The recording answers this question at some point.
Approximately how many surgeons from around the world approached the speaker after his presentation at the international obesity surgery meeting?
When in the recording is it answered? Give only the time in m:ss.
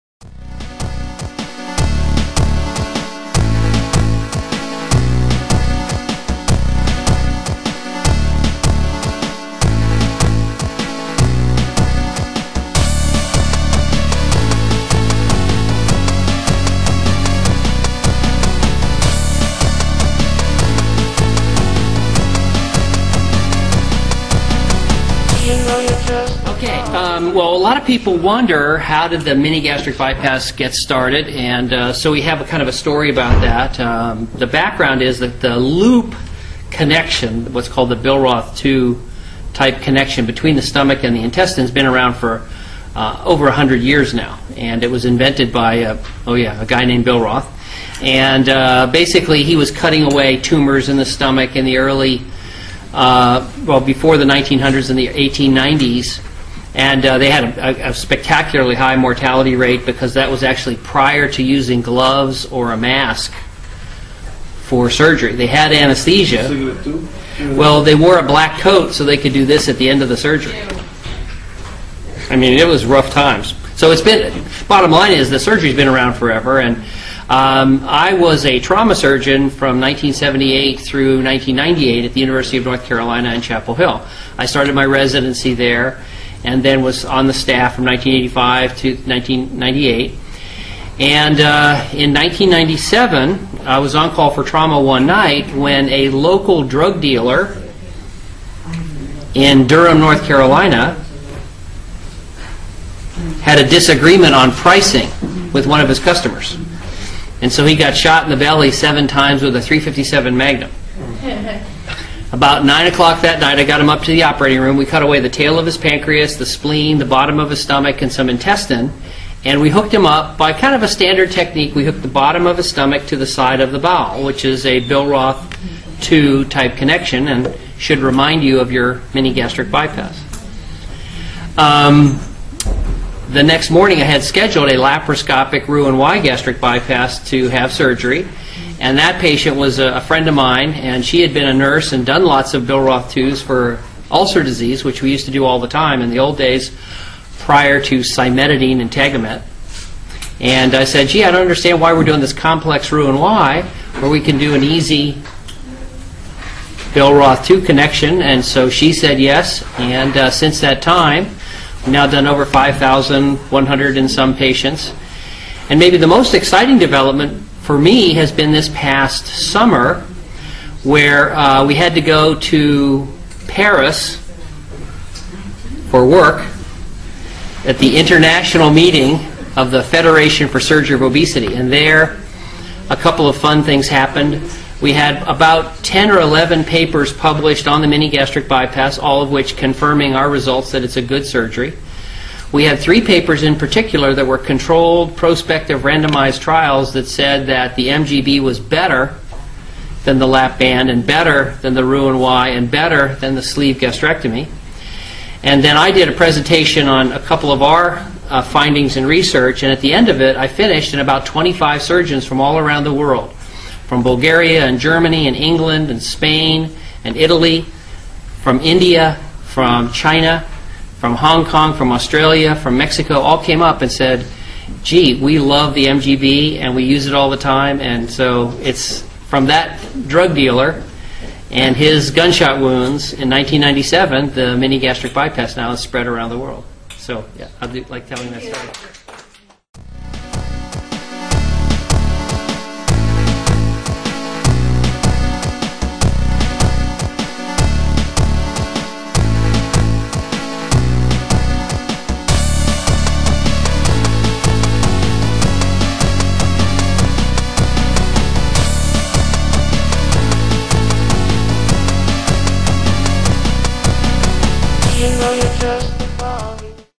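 3:31.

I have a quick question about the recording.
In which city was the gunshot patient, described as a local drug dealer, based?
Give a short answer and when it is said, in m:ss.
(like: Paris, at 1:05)
Durham, North Carolina, at 1:39.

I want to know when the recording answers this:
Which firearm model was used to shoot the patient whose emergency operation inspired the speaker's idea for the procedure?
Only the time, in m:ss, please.
1:49.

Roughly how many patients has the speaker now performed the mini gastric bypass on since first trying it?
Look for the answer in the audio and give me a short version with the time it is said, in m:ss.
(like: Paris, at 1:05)
over 5,100, at 2:42.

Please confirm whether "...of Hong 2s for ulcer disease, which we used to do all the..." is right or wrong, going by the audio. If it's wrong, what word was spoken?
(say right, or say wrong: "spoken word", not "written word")
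wrong: "Billroth", not "Hong".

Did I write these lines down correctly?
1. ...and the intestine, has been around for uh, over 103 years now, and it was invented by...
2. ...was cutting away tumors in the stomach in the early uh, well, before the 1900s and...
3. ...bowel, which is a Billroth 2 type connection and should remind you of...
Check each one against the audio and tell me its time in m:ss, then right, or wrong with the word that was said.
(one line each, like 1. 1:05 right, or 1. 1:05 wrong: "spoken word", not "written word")
1. 0:41 wrong: "100", not "103"
2. 0:49 right
3. 2:03 right.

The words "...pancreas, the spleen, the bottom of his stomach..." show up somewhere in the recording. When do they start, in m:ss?
1:55.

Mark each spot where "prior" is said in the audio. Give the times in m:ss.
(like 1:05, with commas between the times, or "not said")
1:00, 2:27.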